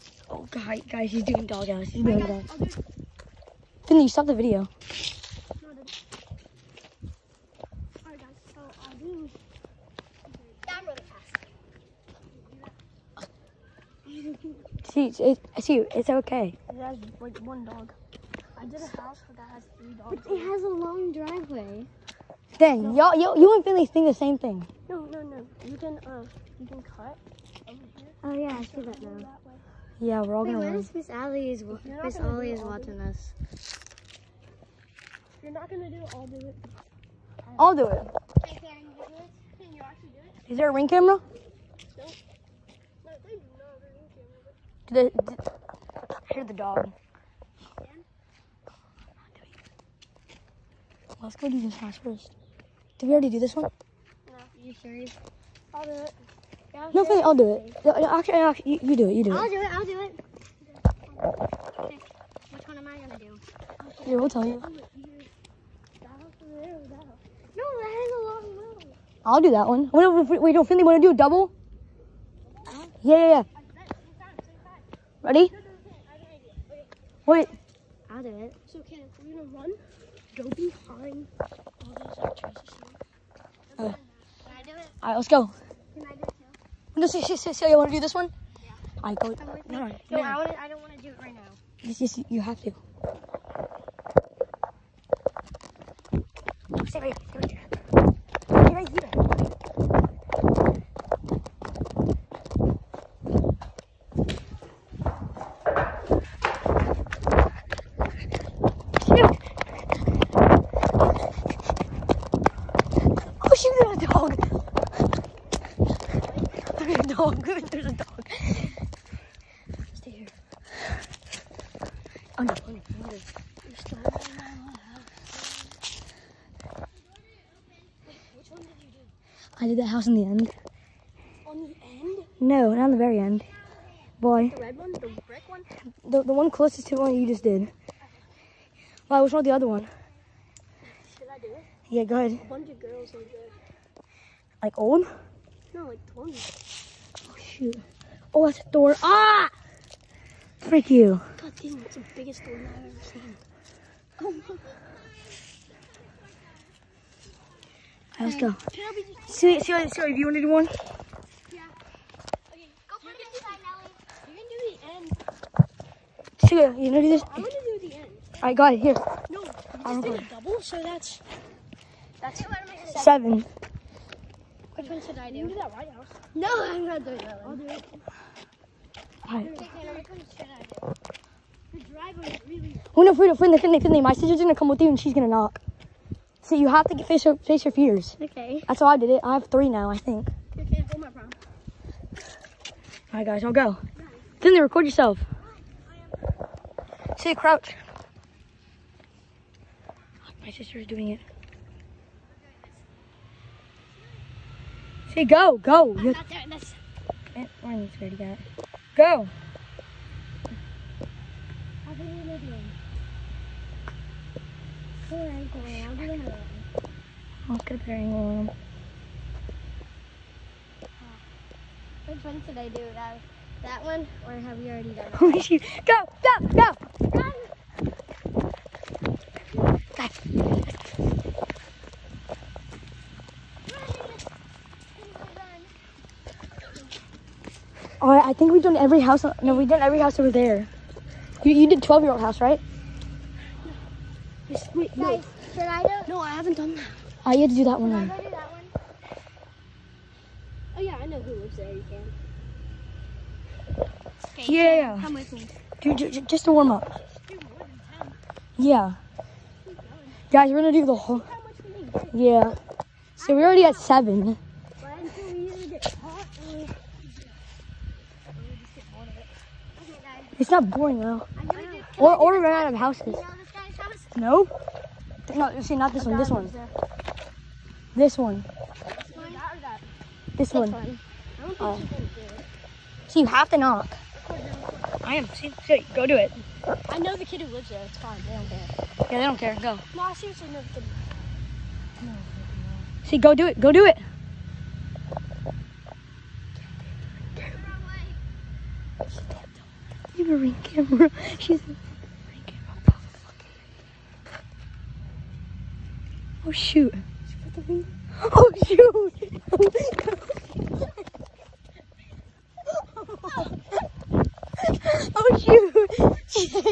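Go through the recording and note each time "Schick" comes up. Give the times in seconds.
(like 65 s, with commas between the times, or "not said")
not said.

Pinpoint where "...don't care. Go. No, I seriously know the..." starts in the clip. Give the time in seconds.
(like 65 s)
289 s.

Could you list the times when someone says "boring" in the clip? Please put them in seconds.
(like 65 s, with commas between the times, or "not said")
270 s.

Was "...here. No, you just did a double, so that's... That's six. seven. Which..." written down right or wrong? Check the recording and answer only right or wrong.
wrong.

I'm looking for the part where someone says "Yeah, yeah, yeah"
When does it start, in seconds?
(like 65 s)
73 s.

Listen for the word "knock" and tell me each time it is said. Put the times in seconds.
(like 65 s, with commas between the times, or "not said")
185 s, 283 s.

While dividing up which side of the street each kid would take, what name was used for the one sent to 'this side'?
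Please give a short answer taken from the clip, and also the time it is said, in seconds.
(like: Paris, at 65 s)
Nelly, at 163 s.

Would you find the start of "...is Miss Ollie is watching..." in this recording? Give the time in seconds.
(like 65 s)
31 s.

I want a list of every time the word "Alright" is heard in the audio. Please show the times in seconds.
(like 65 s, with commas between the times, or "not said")
85 s, 89 s, 179 s, 238 s.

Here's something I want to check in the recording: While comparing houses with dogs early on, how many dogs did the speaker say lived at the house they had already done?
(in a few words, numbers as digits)
3.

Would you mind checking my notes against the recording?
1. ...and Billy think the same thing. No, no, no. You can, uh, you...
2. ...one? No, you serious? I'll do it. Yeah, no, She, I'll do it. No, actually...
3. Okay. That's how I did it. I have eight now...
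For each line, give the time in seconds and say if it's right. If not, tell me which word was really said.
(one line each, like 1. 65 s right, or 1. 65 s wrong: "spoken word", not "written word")
1. 23 s right
2. 53 s wrong: "Faye", not "She"
3. 188 s wrong: "three", not "eight".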